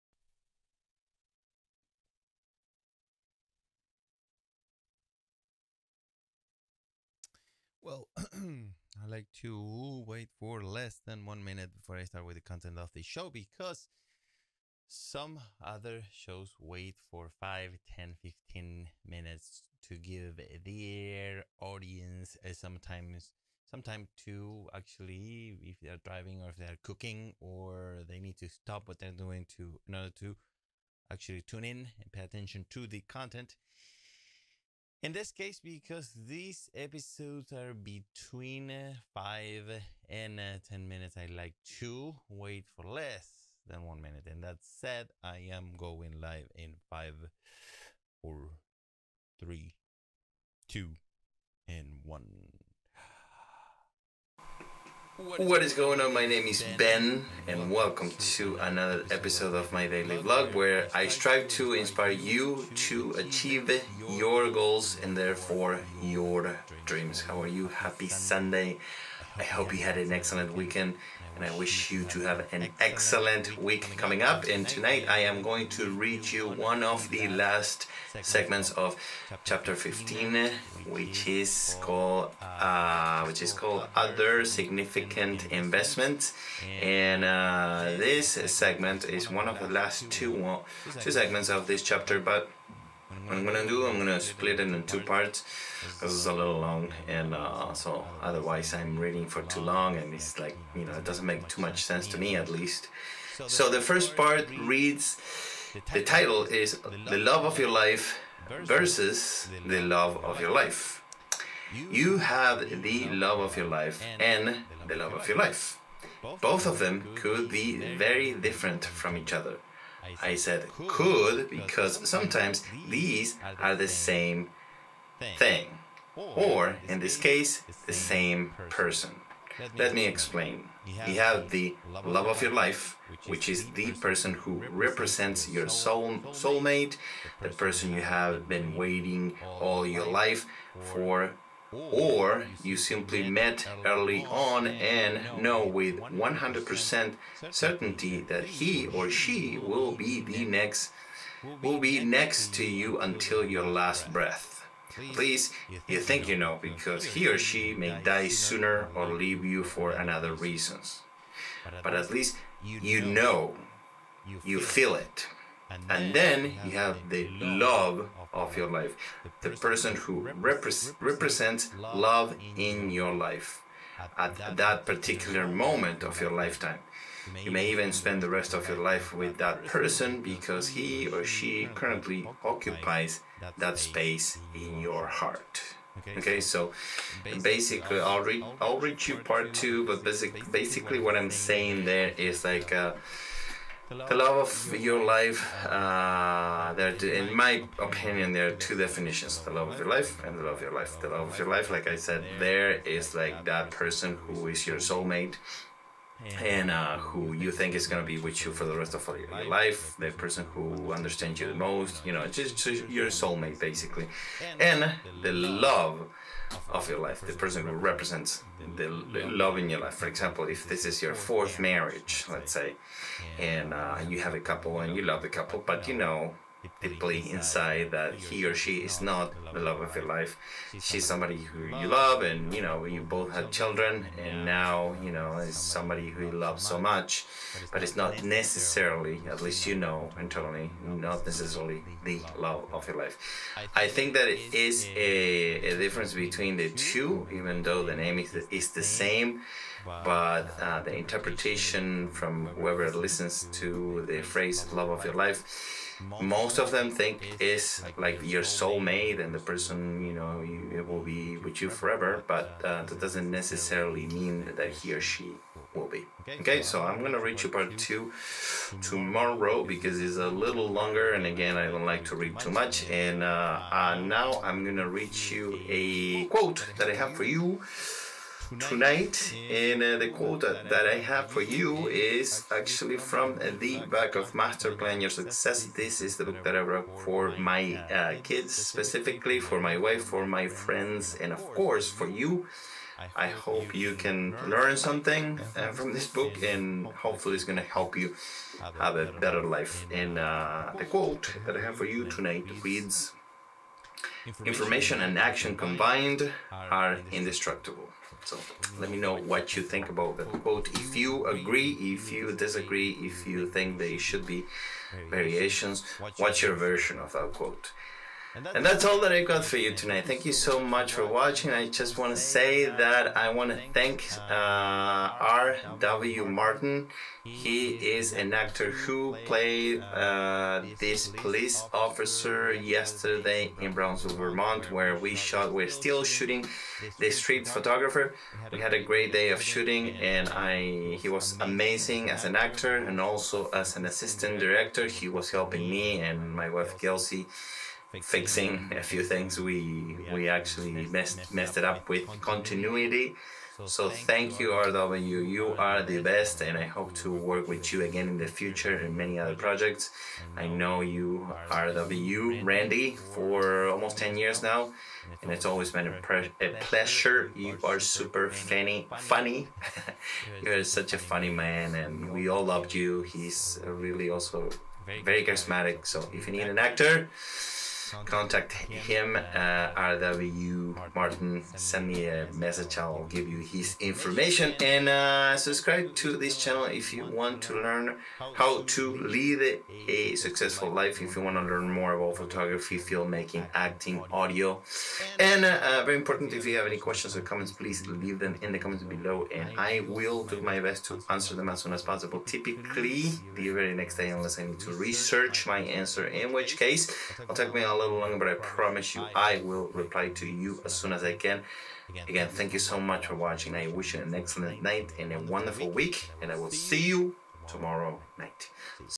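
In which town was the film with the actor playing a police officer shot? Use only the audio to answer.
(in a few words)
Brownsville, Vermont.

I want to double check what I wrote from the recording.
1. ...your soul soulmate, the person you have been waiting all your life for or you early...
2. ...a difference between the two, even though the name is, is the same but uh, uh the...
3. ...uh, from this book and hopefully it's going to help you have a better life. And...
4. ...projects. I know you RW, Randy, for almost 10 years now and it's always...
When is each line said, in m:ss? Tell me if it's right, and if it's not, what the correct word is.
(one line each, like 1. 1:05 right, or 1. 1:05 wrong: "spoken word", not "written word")
1. 2:15 wrong: "simply", not "early"
2. 4:05 right
3. 4:55 right
4. 5:59 right.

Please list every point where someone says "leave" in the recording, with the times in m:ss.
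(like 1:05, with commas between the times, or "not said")
2:39, 6:37.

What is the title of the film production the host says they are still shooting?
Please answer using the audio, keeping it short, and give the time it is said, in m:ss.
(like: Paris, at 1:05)
The Street Photographer, at 5:36.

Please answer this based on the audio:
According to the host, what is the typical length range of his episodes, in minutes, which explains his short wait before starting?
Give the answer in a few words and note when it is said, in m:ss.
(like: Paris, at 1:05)
5 to 10 minutes, at 0:39.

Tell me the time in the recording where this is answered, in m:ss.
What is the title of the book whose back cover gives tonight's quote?
4:44.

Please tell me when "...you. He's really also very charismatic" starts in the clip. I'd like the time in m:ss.
6:12.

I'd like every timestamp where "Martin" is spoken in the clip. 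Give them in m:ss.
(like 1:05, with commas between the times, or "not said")
5:26, 6:20.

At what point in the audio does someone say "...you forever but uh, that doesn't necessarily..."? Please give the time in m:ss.
4:21.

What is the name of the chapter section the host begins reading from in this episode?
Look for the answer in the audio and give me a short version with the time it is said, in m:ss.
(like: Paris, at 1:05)
Other significant investments, at 1:23.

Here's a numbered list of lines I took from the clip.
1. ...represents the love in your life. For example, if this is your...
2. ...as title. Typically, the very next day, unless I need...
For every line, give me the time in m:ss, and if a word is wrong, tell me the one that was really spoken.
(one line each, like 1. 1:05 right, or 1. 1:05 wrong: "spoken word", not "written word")
1. 3:37 right
2. 6:41 wrong: "possible", not "title".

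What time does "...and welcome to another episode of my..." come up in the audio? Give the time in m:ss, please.
0:57.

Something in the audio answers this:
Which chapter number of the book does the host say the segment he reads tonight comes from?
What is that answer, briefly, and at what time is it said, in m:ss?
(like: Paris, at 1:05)
15, at 1:19.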